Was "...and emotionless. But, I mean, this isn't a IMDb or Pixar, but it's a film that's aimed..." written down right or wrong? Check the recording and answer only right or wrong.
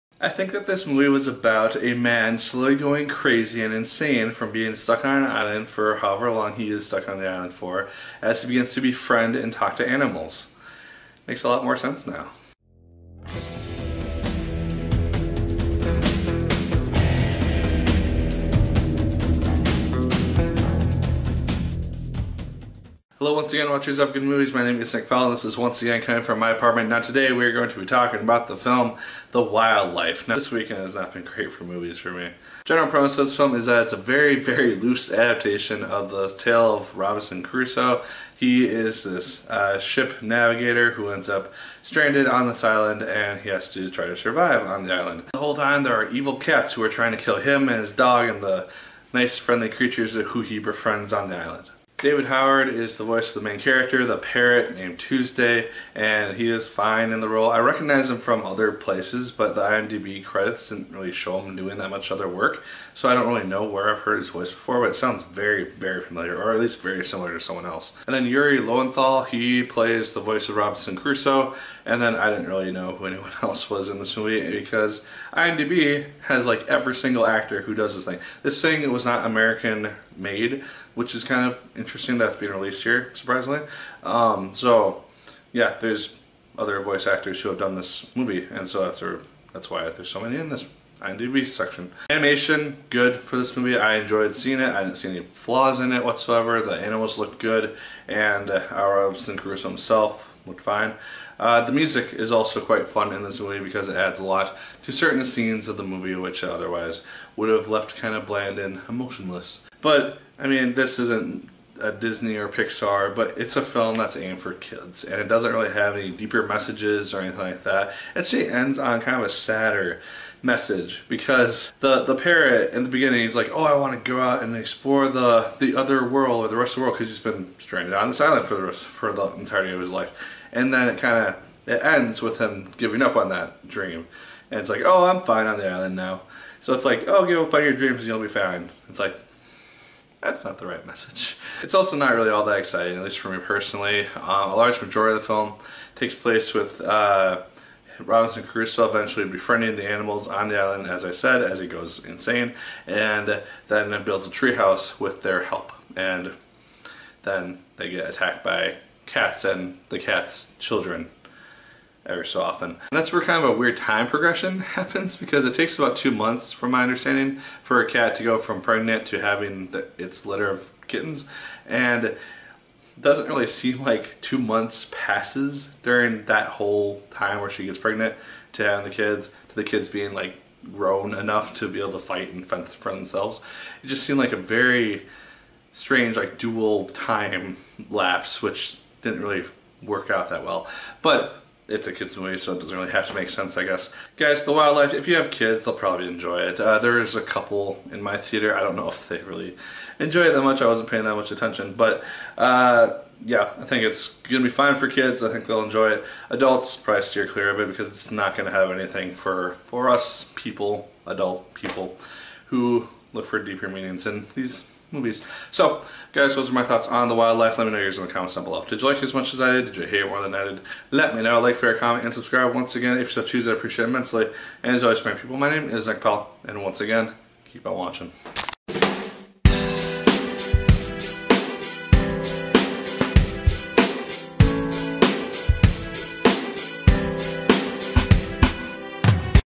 wrong.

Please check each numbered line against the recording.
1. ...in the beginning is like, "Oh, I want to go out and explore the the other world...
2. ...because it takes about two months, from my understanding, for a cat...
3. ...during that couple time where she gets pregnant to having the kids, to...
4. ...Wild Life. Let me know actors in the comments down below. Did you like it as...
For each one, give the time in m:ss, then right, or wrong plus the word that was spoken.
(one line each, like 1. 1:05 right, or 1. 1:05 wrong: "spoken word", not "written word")
1. 2:02 right
2. 2:45 right
3. 2:55 wrong: "whole", not "couple"
4. 3:37 wrong: "yours", not "actors".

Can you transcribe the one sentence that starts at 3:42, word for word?
Once again, if you so choose, I appreciate it immensely.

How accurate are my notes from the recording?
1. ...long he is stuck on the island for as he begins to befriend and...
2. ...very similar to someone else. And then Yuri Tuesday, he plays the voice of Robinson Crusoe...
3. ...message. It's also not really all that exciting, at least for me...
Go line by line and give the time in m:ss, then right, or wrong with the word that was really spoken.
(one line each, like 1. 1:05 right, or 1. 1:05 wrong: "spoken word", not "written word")
1. 0:06 right
2. 1:06 wrong: "Lowenthal", not "Tuesday"
3. 2:20 right.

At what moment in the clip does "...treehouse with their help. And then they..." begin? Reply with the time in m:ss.
2:34.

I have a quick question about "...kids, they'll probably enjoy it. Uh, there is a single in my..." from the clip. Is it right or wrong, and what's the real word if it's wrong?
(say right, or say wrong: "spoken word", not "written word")
wrong: "couple", not "single".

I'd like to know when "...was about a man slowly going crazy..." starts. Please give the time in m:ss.
0:01.